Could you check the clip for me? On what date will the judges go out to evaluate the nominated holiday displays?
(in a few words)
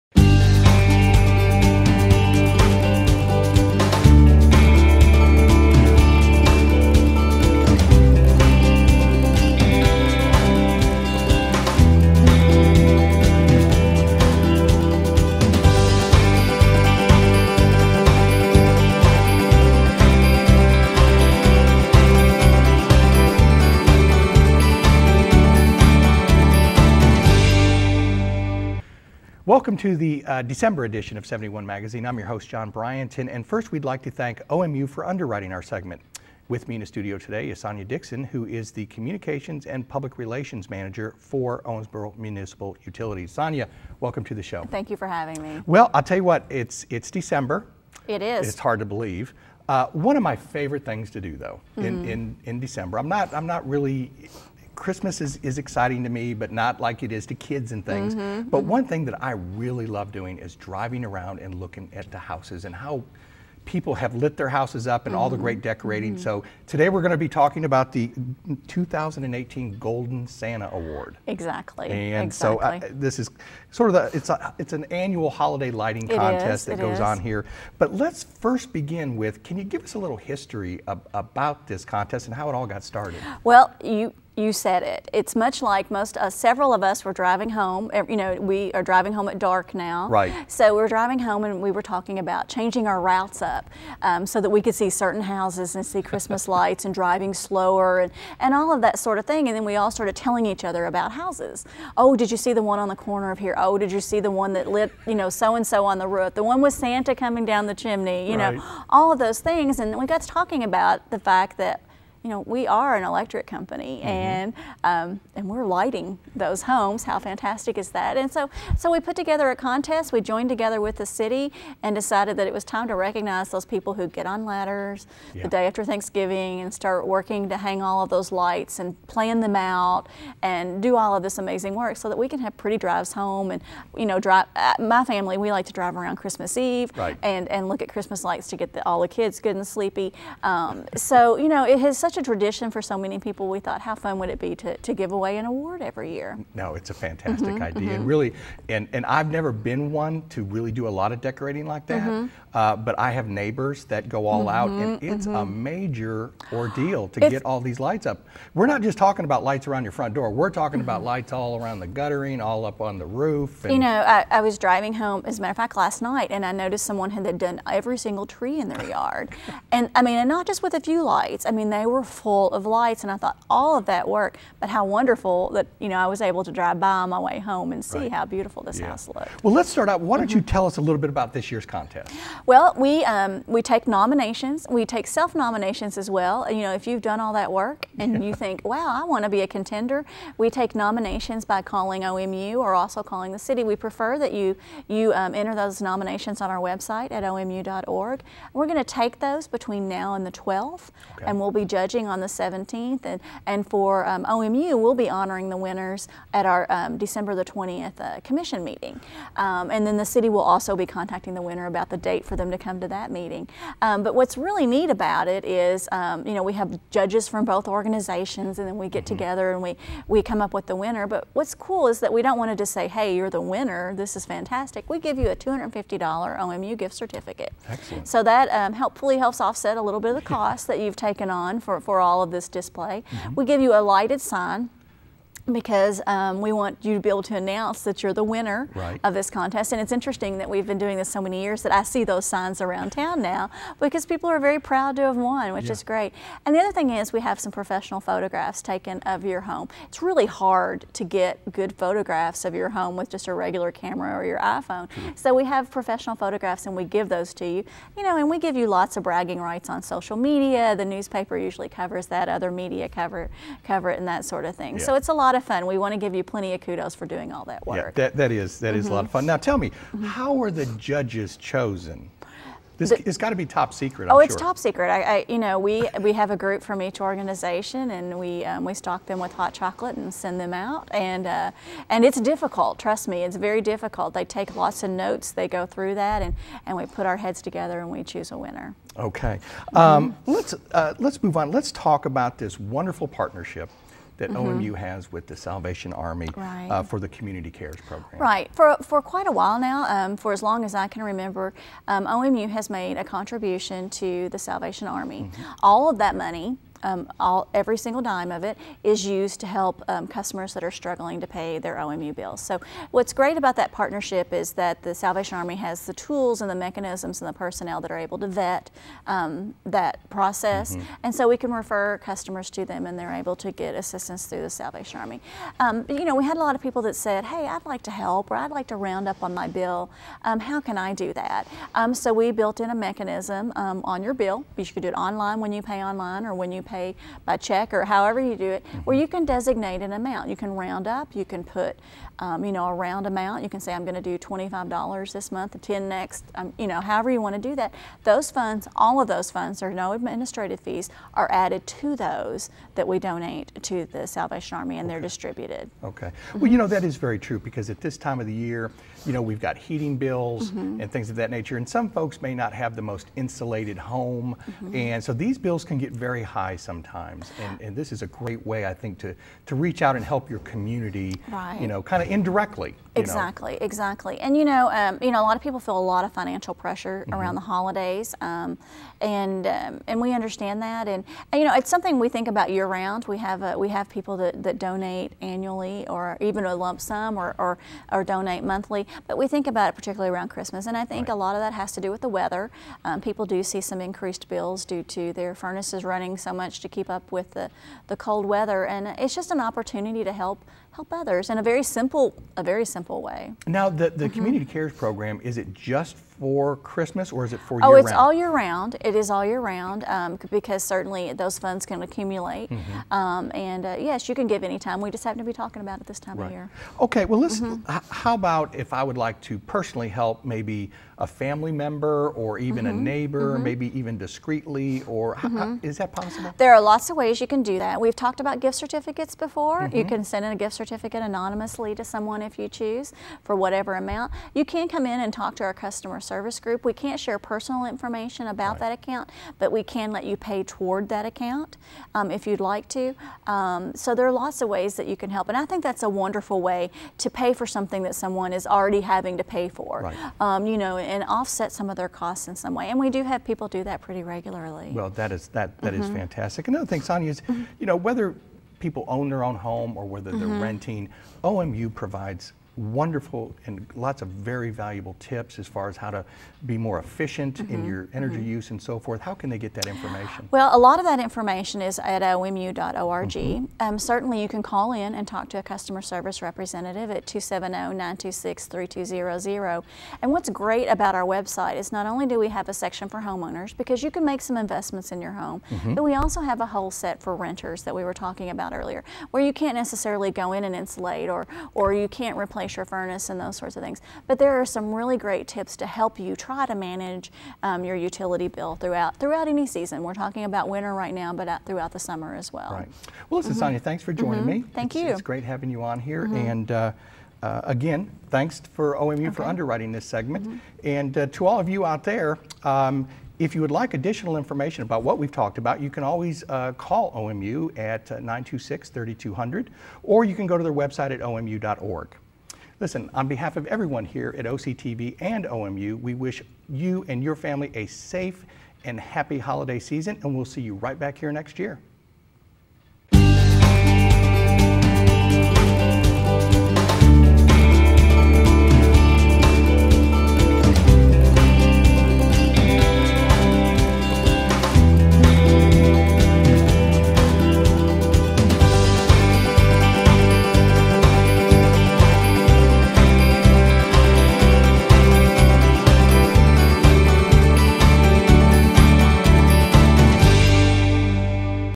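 the 17th.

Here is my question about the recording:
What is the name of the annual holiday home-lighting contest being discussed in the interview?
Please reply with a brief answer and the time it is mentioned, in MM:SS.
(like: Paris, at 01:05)
Golden Santa Award, at 01:09.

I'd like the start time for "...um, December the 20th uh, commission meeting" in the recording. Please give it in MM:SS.
03:26.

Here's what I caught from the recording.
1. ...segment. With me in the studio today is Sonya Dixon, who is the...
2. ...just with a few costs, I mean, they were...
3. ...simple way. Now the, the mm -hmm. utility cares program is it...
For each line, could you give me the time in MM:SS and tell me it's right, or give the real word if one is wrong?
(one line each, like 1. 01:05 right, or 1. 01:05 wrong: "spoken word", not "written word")
1. 00:35 right
2. 02:50 wrong: "lights", not "costs"
3. 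06:42 wrong: "community", not "utility".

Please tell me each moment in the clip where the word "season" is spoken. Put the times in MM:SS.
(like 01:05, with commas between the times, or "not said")
08:19, 08:49.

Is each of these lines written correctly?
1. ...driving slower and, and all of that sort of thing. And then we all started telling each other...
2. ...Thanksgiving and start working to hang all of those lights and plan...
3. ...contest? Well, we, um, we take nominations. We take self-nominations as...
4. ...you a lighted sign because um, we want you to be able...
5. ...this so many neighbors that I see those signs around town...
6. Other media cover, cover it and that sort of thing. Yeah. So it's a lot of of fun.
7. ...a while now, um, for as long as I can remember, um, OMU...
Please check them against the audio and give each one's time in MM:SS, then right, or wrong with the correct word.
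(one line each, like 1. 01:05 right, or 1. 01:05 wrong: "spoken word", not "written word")
1. 01:36 right
2. 02:05 right
3. 03:01 right
4. 03:53 right
5. 04:00 wrong: "years", not "neighbors"
6. 04:22 right
7. 04:59 right.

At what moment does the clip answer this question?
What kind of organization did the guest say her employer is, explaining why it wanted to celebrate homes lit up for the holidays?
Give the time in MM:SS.
01:53.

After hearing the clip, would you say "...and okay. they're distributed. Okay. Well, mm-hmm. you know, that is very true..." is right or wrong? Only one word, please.
right.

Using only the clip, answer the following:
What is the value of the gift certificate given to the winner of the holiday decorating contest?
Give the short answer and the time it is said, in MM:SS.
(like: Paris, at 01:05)
$250, at 03:45.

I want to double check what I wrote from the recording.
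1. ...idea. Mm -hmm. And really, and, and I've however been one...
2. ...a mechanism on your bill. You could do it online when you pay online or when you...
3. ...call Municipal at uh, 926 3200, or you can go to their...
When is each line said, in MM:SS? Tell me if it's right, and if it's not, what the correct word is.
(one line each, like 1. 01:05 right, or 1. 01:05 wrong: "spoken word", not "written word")
1. 02:27 wrong: "never", not "however"
2. 05:32 right
3. 08:36 wrong: "OMU", not "Municipal".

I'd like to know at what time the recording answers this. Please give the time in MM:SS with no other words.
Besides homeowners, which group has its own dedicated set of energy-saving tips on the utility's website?
08:07.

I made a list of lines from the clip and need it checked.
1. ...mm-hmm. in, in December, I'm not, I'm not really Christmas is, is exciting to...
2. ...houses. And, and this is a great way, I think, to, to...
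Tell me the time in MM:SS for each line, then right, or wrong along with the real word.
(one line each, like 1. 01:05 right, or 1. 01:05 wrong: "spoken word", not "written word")
1. 00:51 right
2. 06:06 wrong: "sometimes", not "houses".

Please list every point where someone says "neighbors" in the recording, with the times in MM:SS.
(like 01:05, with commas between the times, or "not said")
02:33, 07:02.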